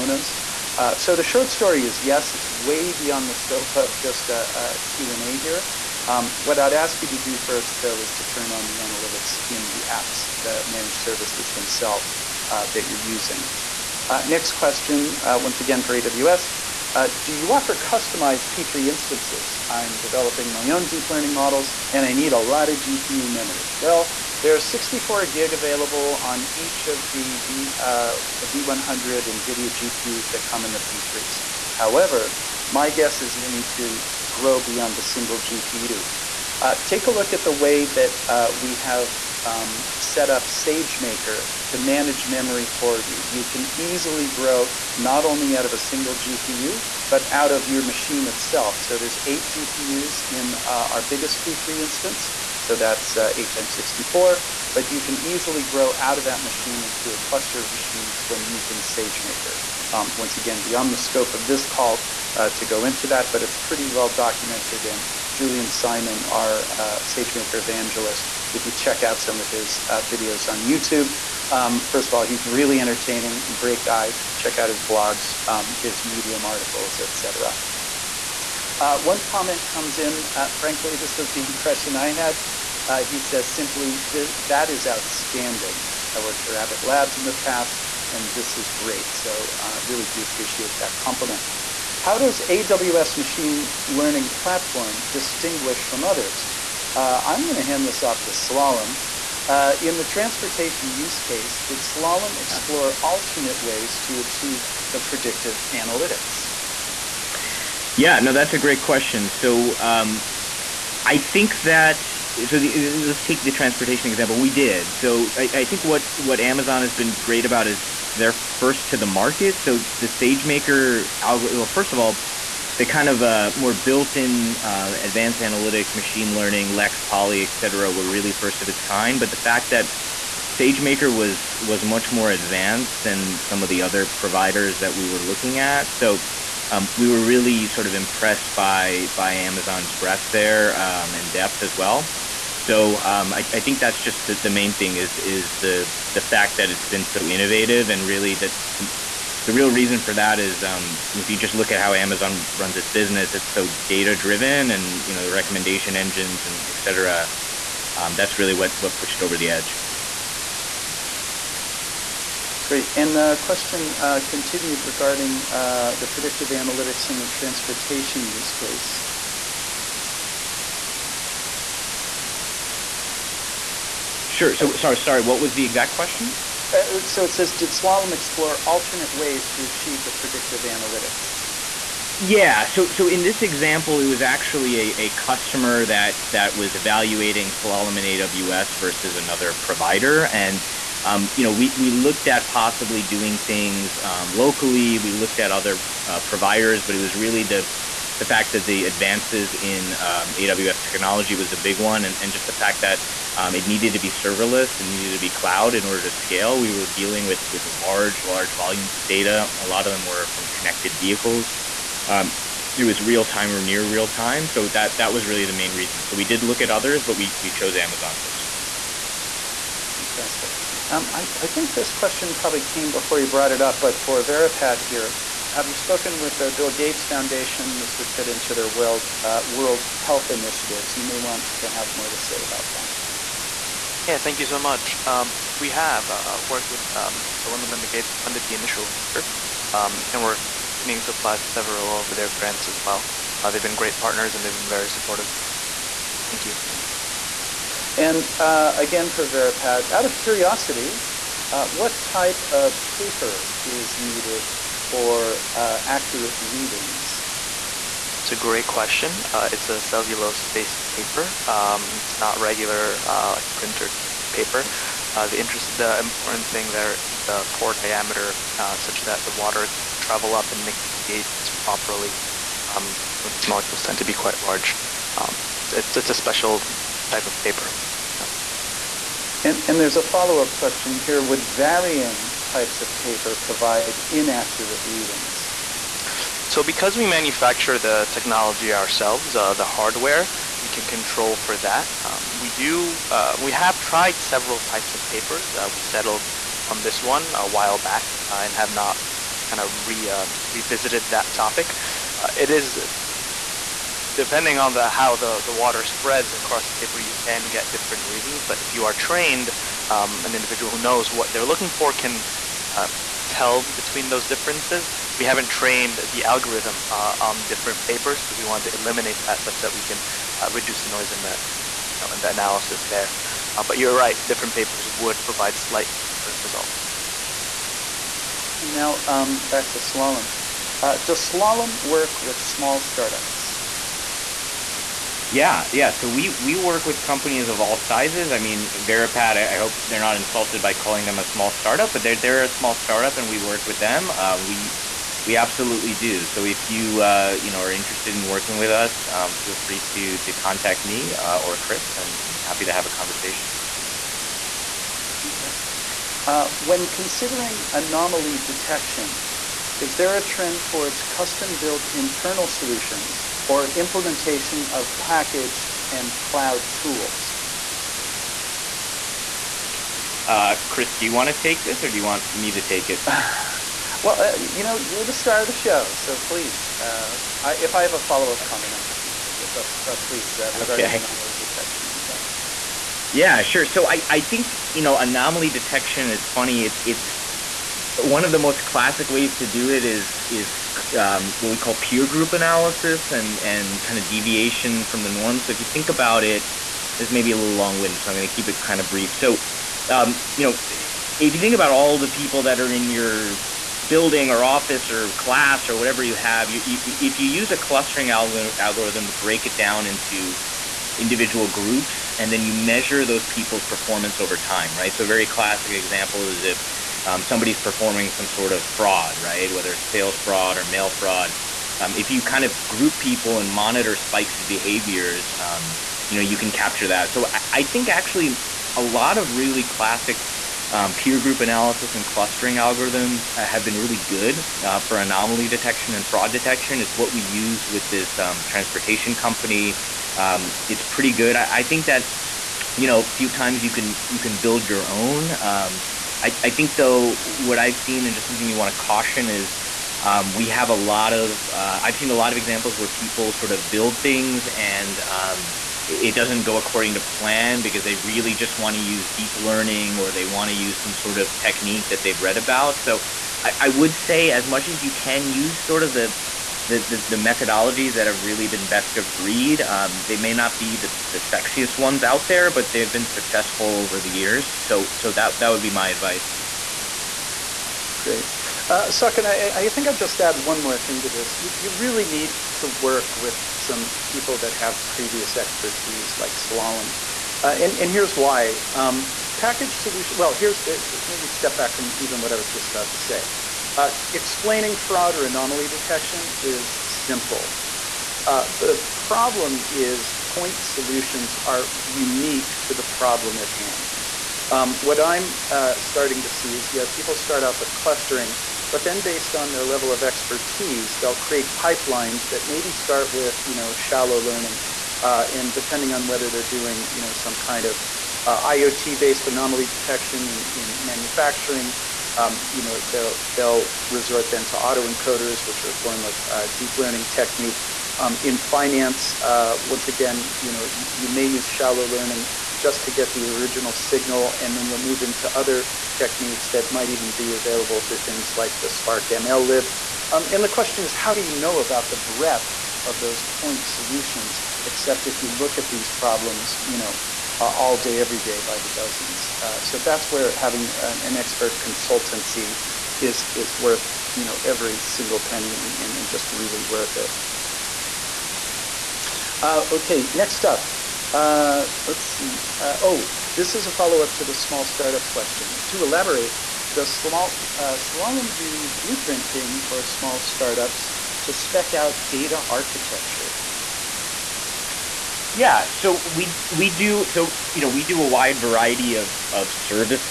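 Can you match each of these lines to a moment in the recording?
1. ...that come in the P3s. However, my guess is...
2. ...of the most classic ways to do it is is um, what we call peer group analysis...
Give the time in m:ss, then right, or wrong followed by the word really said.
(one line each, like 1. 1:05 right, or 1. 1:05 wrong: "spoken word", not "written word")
1. 0:30 right
2. 6:28 right.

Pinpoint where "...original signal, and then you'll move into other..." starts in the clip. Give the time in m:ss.
8:53.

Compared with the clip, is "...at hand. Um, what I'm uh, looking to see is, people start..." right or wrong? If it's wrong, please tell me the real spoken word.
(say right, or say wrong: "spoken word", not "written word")
wrong: "starting", not "looking".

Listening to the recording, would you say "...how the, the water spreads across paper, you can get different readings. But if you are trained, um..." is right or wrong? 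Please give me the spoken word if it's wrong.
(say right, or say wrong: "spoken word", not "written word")
right.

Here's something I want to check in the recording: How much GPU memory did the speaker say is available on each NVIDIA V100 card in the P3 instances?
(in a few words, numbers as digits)
64 gig.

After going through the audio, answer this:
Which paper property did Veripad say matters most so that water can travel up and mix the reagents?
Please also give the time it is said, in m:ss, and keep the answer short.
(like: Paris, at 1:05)
pore diameter, at 4:27.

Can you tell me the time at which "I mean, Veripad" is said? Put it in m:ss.
5:38.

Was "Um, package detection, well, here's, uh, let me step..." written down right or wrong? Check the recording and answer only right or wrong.
wrong.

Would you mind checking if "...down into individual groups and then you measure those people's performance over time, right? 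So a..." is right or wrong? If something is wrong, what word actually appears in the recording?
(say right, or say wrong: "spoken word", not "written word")
right.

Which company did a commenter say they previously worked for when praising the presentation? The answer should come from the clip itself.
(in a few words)
Abbott Labs.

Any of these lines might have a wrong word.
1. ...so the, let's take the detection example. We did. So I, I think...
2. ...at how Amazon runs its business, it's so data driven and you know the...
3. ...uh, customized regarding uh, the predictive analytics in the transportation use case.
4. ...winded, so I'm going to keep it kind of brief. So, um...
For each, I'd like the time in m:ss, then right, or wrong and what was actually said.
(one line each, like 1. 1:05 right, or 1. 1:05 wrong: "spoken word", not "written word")
1. 1:52 wrong: "transportation", not "detection"
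2. 2:31 right
3. 2:43 wrong: "continued", not "customized"
4. 6:37 right.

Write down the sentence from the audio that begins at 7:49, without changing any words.
Um, they may not be the, the sexiest ones out there, but they've been successful over the years.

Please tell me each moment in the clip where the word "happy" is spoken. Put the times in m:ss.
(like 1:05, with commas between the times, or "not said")
5:52, 6:18.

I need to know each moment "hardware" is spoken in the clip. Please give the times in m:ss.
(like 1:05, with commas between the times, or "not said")
4:49.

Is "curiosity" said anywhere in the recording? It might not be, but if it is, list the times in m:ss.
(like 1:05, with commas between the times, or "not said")
4:10.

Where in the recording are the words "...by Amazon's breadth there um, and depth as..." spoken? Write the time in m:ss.
2:19.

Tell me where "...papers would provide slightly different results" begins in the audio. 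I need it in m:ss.
5:24.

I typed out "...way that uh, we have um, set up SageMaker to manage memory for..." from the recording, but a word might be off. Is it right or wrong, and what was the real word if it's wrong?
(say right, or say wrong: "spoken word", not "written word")
right.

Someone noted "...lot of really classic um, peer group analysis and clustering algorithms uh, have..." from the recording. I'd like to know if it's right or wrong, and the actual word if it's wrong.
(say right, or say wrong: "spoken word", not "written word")
right.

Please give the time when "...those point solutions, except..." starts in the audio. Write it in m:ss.
9:03.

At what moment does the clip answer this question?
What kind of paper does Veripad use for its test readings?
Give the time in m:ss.
4:19.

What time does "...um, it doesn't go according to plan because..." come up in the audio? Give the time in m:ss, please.
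7:35.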